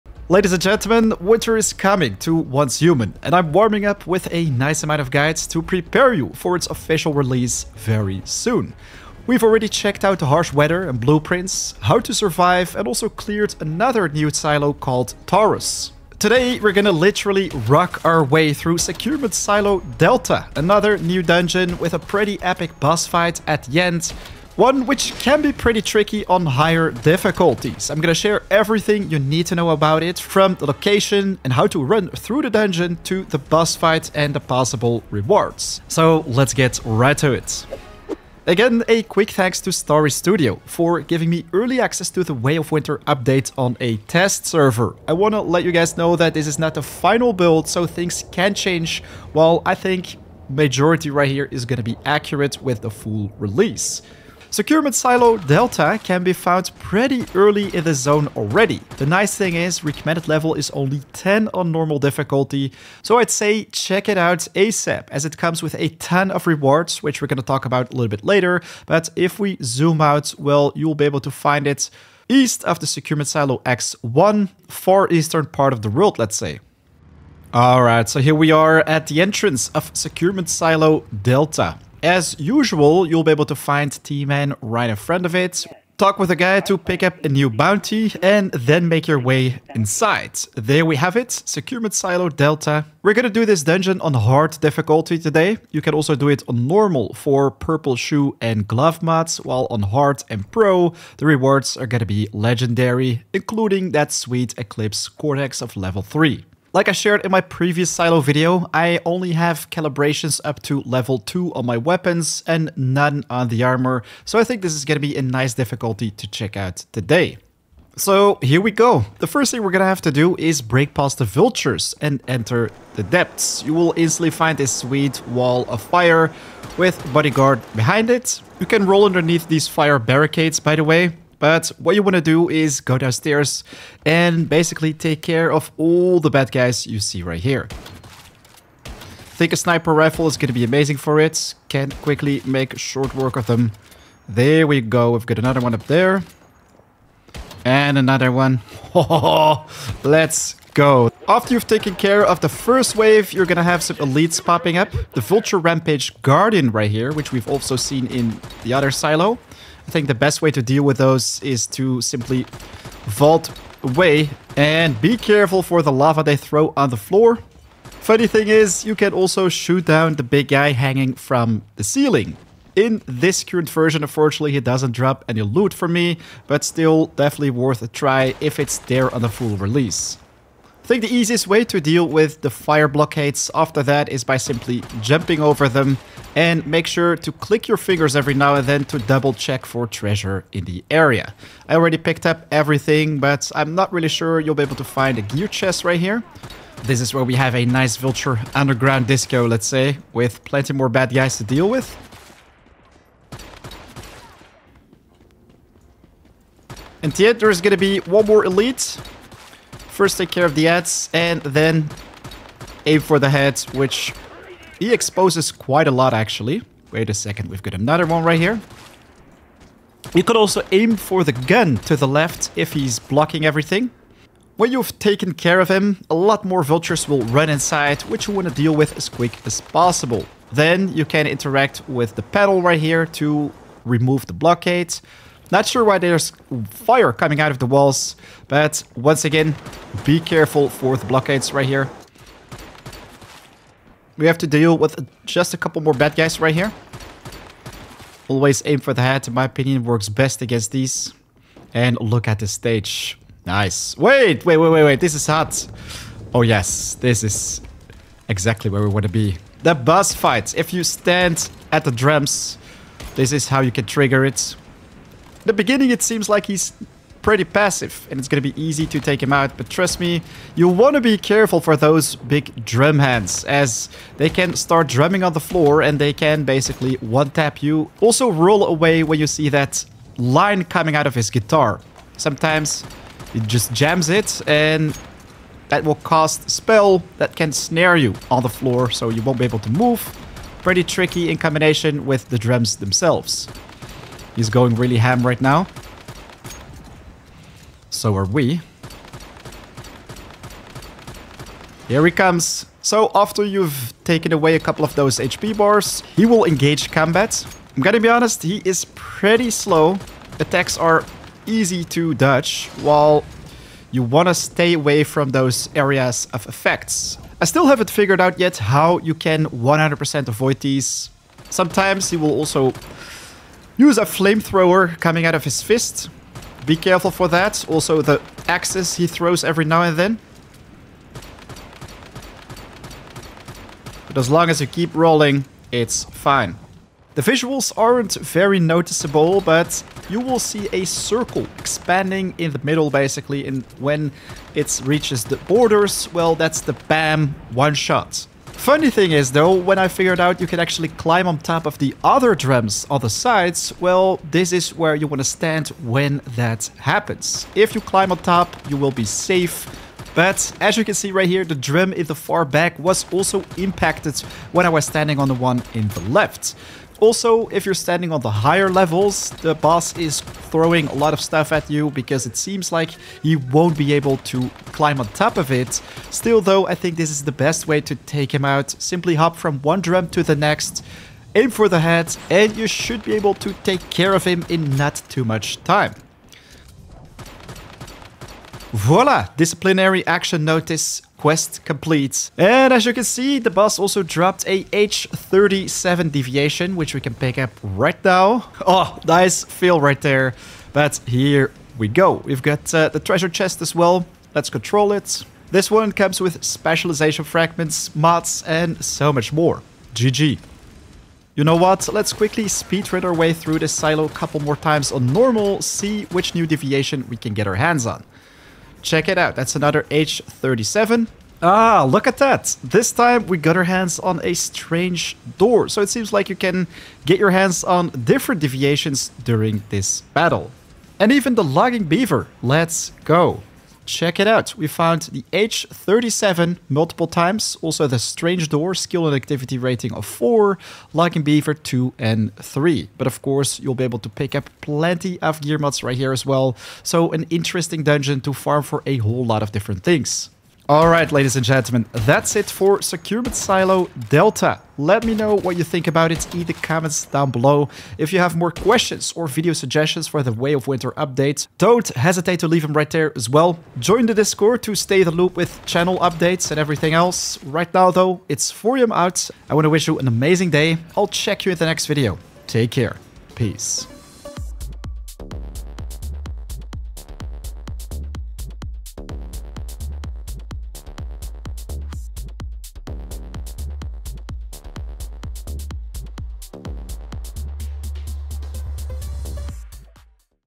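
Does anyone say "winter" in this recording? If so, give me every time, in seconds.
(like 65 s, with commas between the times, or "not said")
1 s, 42 s, 460 s.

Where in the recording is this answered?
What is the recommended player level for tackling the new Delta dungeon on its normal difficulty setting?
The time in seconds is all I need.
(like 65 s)
61 s.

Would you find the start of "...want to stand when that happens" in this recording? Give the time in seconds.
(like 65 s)
355 s.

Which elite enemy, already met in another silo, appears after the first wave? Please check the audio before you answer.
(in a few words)
Vulture Rampage Guardian.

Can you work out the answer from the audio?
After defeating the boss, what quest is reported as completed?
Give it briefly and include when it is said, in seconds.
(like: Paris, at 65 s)
Disciplinary action notice, at 389 s.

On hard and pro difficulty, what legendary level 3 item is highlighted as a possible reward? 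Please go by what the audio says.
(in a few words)
Eclipse Cortex.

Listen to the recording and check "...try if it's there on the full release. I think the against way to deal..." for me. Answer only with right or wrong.
wrong.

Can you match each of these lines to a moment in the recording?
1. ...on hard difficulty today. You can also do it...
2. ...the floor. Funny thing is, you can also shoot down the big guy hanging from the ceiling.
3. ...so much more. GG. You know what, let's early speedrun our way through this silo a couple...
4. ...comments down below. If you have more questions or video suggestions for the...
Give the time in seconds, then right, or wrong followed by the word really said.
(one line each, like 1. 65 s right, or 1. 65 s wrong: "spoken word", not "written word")
1. 94 s right
2. 166 s right
3. 408 s wrong: "quickly", not "early"
4. 456 s right.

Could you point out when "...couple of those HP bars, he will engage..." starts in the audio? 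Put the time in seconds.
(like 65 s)
304 s.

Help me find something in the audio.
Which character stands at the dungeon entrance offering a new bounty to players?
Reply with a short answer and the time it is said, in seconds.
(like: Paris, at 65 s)
T-Man, at 84 s.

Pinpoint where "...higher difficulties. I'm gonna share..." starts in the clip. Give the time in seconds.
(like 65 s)
26 s.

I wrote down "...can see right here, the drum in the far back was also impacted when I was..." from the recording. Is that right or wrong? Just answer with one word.
right.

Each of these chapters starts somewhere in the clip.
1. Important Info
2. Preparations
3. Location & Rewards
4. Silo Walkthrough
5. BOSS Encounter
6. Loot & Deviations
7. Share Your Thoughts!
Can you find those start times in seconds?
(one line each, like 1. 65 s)
1. 40 s
2. 50 s
3. 80 s
4. 130 s
5. 285 s
6. 410 s
7. 450 s.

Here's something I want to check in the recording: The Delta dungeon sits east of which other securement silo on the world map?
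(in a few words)
Securement Silo X1.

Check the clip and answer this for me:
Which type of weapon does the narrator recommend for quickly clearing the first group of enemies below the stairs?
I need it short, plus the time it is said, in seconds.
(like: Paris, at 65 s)
Sniper rifle, at 139 s.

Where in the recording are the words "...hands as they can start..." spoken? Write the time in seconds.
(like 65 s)
272 s.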